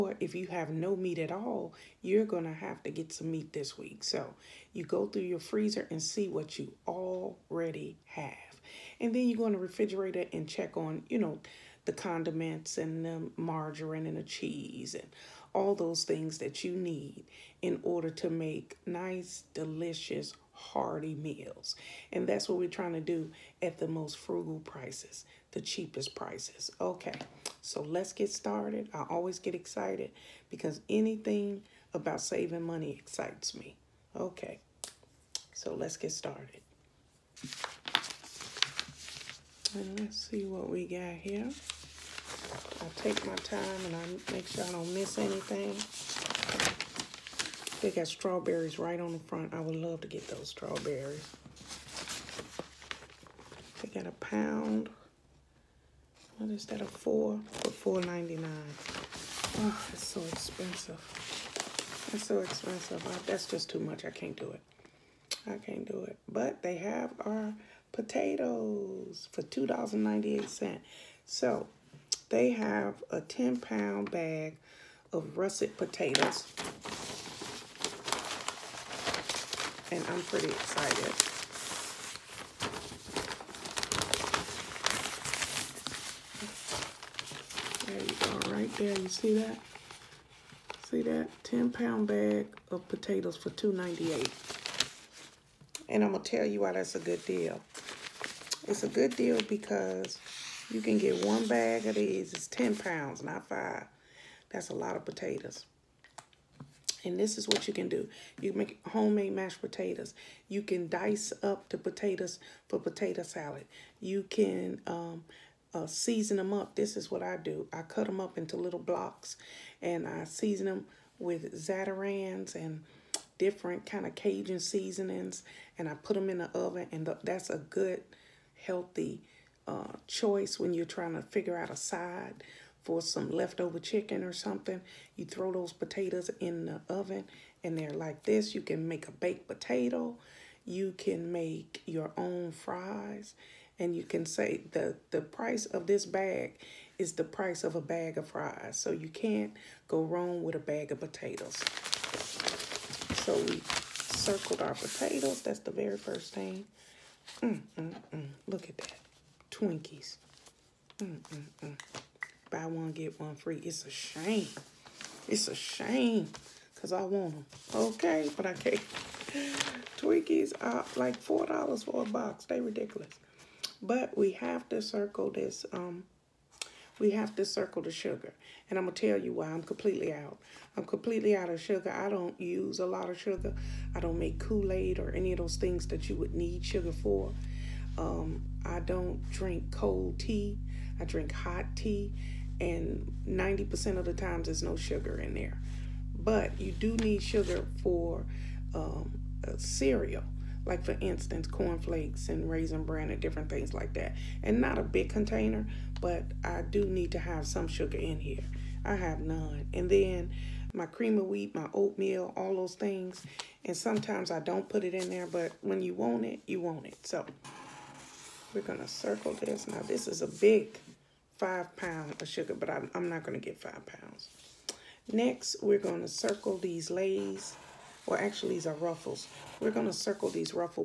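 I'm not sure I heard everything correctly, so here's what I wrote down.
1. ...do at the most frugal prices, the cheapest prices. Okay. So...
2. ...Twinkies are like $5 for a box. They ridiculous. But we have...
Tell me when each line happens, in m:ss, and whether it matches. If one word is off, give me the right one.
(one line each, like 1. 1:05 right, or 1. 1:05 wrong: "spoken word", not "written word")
1. 0:22 right
2. 2:49 wrong: "4", not "5".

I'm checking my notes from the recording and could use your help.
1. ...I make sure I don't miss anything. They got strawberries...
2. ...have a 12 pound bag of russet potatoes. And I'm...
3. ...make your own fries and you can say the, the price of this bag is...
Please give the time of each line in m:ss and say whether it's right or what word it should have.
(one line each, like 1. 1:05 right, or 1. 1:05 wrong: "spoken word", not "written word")
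1. 0:43 right
2. 1:12 wrong: "10", not "12"
3. 2:21 right.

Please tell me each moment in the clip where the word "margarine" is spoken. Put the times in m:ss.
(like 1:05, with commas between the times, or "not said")
0:13.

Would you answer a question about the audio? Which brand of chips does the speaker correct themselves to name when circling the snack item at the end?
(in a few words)
Ruffles.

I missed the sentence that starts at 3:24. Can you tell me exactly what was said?
And not a big container, but I do need to have some sugar in here.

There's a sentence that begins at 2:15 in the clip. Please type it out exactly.
You throw those potatoes in the oven and they're like this.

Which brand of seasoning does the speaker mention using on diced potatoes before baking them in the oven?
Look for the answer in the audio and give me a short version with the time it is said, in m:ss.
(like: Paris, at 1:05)
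Zatarain's, at 2:01.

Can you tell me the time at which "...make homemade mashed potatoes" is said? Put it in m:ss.
1:48.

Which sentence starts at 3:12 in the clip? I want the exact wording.
And 90% of the times there's no sugar in there.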